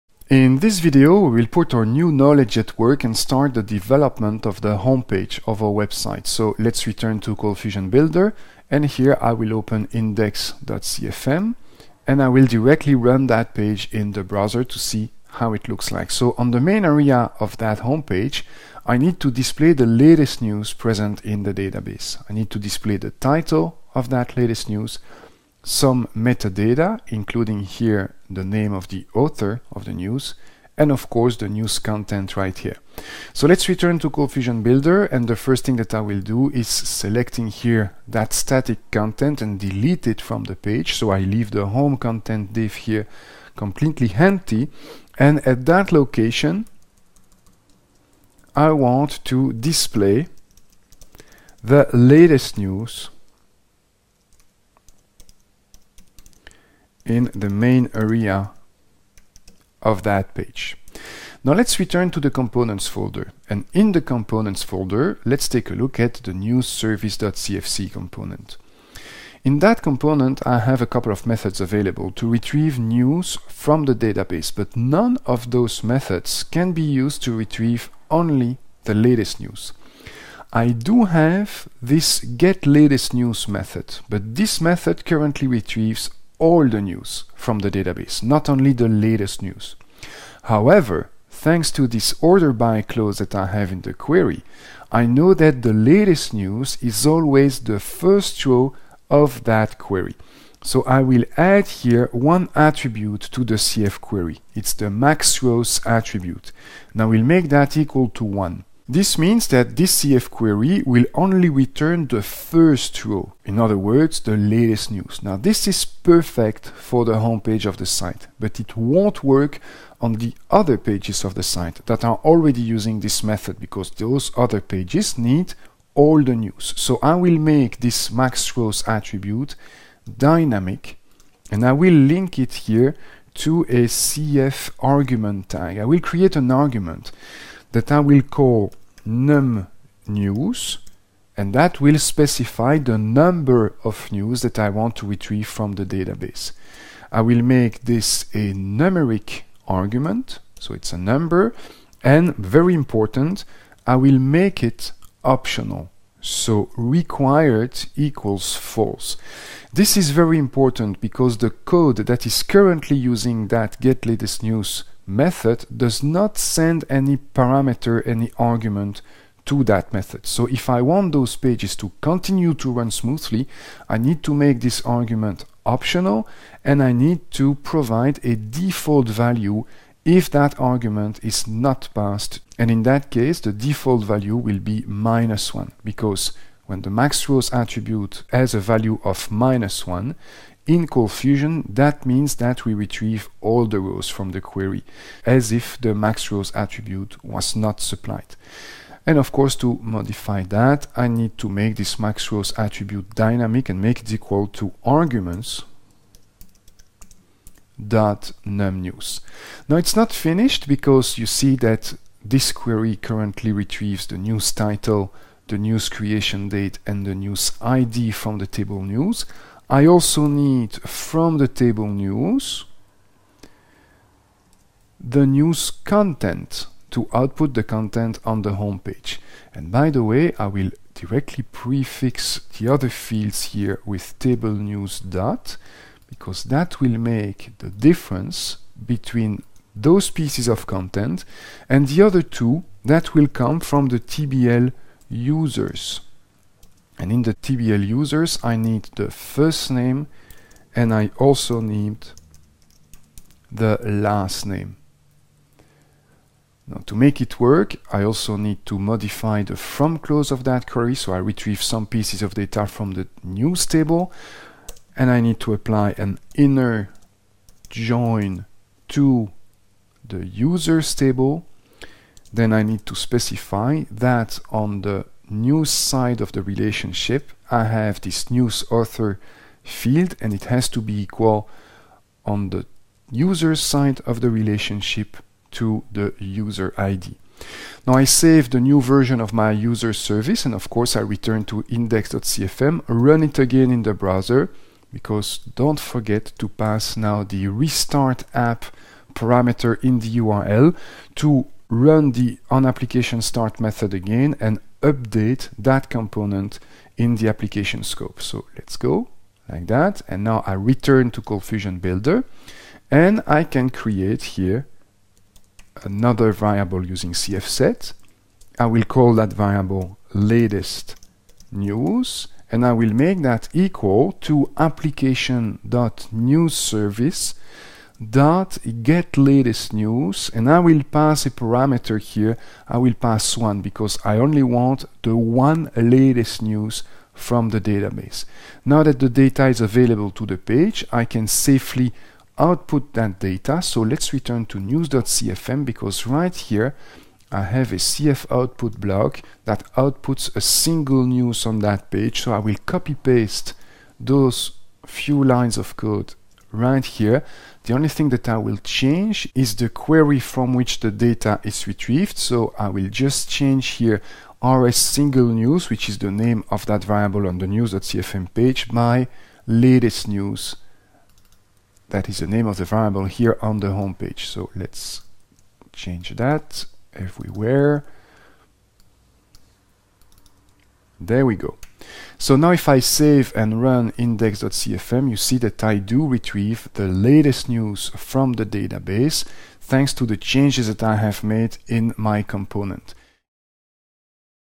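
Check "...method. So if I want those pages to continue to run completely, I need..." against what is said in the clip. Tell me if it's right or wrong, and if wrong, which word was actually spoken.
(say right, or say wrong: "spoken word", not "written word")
wrong: "smoothly", not "completely".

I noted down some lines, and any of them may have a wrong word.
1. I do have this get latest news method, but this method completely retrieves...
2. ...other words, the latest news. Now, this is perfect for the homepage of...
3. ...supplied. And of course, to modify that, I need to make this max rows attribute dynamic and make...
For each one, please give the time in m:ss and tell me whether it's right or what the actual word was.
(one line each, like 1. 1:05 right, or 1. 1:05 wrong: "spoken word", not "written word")
1. 1:20 wrong: "currently", not "completely"
2. 1:53 right
3. 3:17 right.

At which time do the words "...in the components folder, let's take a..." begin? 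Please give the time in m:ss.
1:03.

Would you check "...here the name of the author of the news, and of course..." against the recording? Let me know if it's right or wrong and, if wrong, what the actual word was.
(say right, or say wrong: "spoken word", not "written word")
right.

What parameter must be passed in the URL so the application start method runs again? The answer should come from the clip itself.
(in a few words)
restart app.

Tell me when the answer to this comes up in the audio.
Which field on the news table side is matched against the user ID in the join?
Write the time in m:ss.
4:38.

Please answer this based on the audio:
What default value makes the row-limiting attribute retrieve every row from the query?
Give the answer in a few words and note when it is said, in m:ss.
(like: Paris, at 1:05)
-1, at 3:04.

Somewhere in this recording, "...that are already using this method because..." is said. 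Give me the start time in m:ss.
2:01.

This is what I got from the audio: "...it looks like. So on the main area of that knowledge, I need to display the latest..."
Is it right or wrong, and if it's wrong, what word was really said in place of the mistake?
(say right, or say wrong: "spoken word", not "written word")
wrong: "homepage", not "knowledge".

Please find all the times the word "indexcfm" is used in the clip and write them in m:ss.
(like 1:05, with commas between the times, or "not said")
0:09, 4:51, 6:23.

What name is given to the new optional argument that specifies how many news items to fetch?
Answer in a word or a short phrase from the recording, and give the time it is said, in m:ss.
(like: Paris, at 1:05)
numnews, at 2:19.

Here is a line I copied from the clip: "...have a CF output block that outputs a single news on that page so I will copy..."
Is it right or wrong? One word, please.
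right.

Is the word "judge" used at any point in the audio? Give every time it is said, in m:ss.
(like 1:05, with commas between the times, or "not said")
not said.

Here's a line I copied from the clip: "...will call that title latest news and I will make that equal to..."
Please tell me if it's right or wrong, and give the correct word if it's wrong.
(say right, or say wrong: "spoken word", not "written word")
wrong: "variable", not "title".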